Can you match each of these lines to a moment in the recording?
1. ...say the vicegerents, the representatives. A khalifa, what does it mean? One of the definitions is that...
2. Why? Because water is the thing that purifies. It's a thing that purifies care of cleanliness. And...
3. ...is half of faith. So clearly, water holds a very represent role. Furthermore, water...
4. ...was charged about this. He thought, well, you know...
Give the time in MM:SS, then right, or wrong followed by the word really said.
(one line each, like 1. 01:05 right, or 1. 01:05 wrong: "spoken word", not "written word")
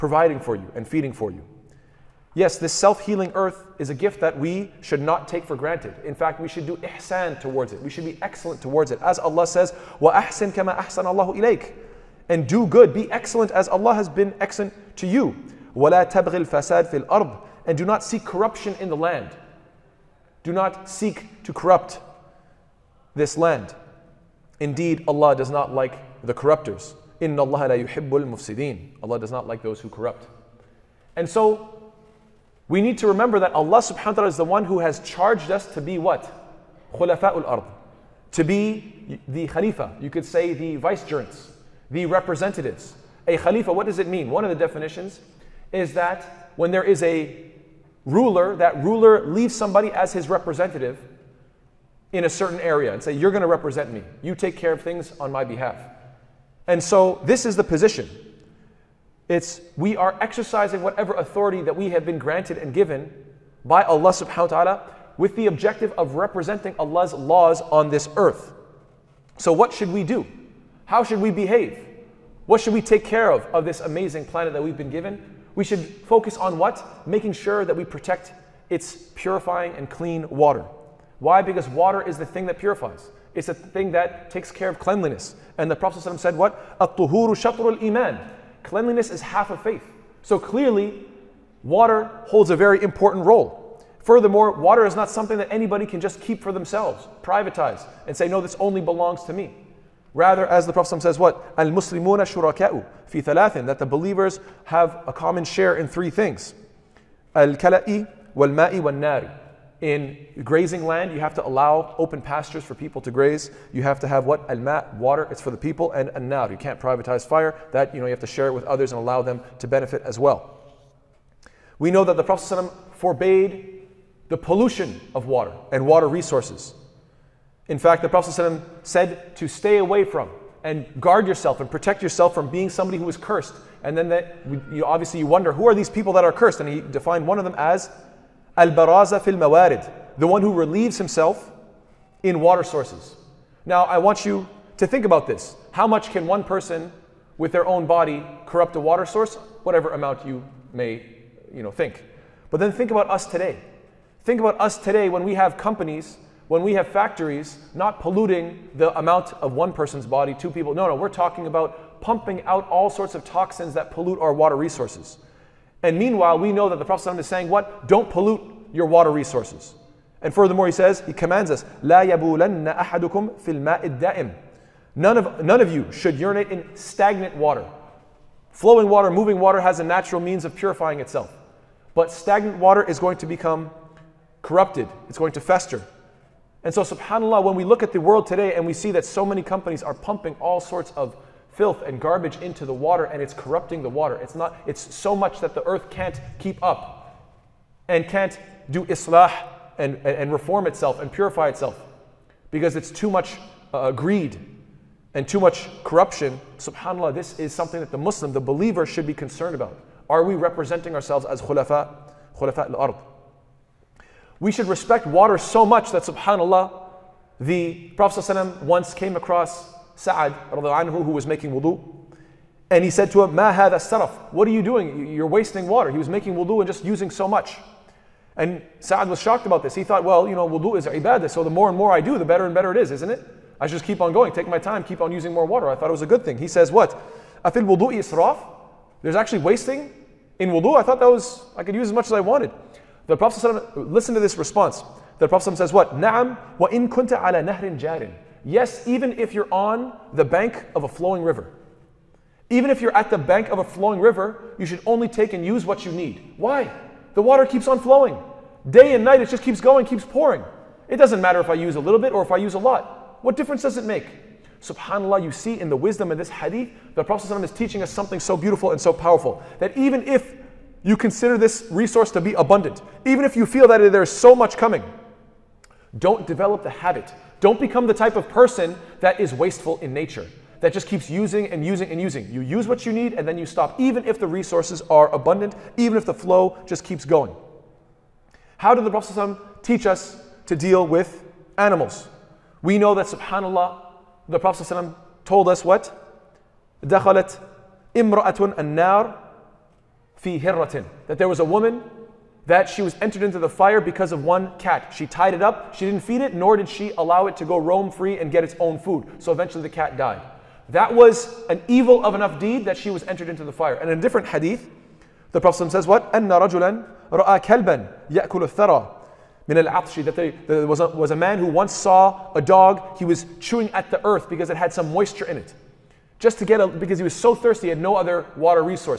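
1. 00:40 right
2. 01:21 wrong: "takes", not "purifies"
3. 01:29 wrong: "important", not "represent"
4. 03:49 wrong: "shocked", not "charged".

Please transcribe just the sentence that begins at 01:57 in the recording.
That, you know, you have to share it with others and allow them to benefit as well.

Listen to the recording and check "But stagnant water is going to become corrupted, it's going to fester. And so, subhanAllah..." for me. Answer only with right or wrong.
right.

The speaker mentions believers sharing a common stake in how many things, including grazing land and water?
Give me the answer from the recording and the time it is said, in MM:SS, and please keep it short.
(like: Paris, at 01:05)
3, at 01:43.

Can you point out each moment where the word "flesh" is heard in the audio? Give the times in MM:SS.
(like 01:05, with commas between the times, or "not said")
not said.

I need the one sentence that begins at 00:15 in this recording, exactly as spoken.
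وَلَا تَبْغِ الْفَسَادِ فِي الْأَرْضِ And do not seek corruption in the land.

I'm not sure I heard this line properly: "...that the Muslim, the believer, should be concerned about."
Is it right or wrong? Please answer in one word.
right.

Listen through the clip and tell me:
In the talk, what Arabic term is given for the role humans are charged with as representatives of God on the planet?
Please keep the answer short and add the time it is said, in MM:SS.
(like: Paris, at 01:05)
Khulafa'ul ard, at 00:36.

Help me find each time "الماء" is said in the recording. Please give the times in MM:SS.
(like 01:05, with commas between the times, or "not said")
02:53.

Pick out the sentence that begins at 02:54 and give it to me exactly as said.
None of, none of you should urinate in stagnant water.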